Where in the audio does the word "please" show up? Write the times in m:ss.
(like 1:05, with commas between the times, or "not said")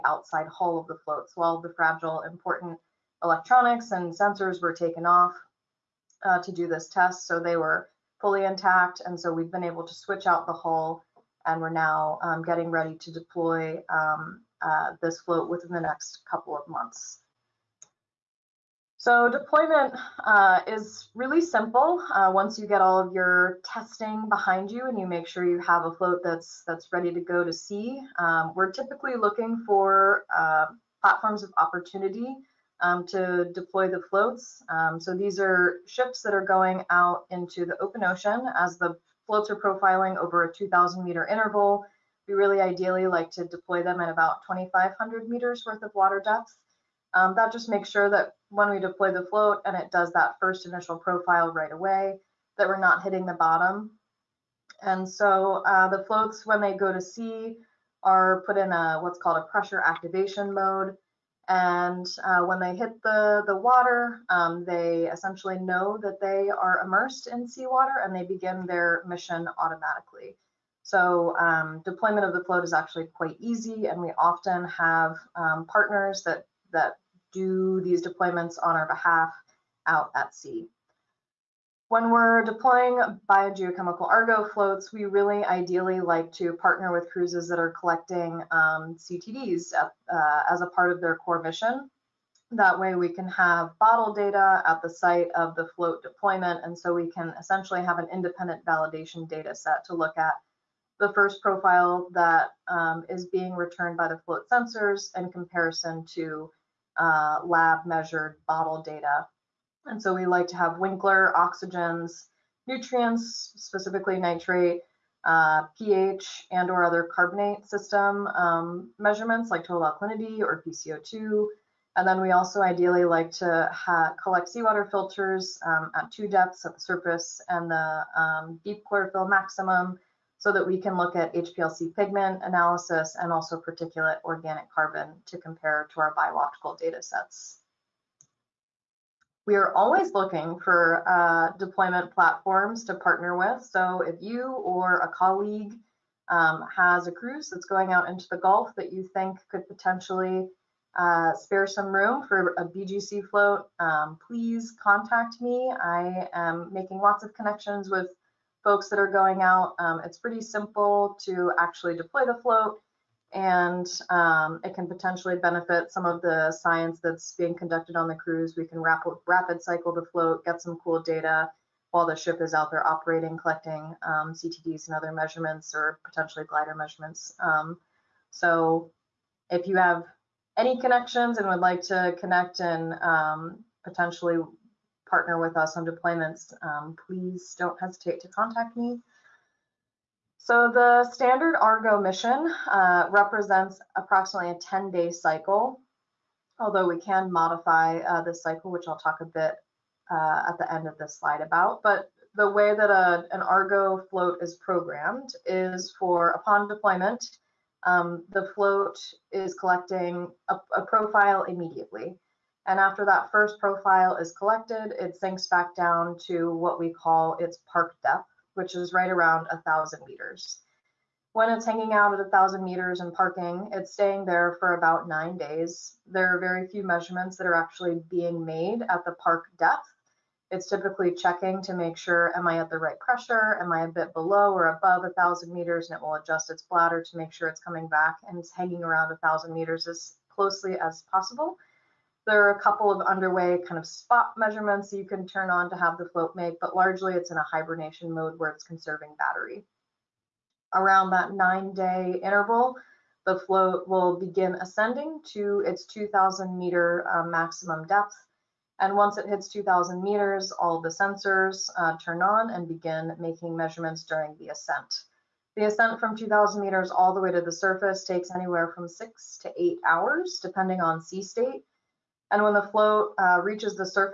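2:34, 3:07.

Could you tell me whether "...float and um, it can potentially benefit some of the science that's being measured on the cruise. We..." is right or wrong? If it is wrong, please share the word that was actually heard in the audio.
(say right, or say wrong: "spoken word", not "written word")
wrong: "conducted", not "measured".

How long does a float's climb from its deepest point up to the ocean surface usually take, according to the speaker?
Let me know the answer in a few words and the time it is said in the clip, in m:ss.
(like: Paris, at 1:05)
6 to 8 hours, at 4:28.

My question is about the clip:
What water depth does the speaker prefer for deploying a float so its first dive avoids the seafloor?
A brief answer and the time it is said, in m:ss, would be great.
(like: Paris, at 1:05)
2,500 meters, at 0:44.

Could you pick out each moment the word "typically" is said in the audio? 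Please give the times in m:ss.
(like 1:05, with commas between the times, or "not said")
0:28, 3:50.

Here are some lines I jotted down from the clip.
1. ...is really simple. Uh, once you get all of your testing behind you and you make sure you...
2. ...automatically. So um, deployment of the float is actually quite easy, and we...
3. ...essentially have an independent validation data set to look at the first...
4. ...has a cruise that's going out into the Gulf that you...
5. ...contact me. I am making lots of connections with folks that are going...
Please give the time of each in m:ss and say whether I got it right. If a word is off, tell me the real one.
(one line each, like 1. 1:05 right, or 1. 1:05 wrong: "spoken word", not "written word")
1. 0:20 right
2. 1:09 right
3. 1:37 right
4. 2:26 right
5. 2:34 right.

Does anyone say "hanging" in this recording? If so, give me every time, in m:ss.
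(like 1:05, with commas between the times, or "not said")
3:41, 3:58.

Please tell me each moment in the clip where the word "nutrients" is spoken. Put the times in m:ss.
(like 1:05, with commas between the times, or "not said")
1:52.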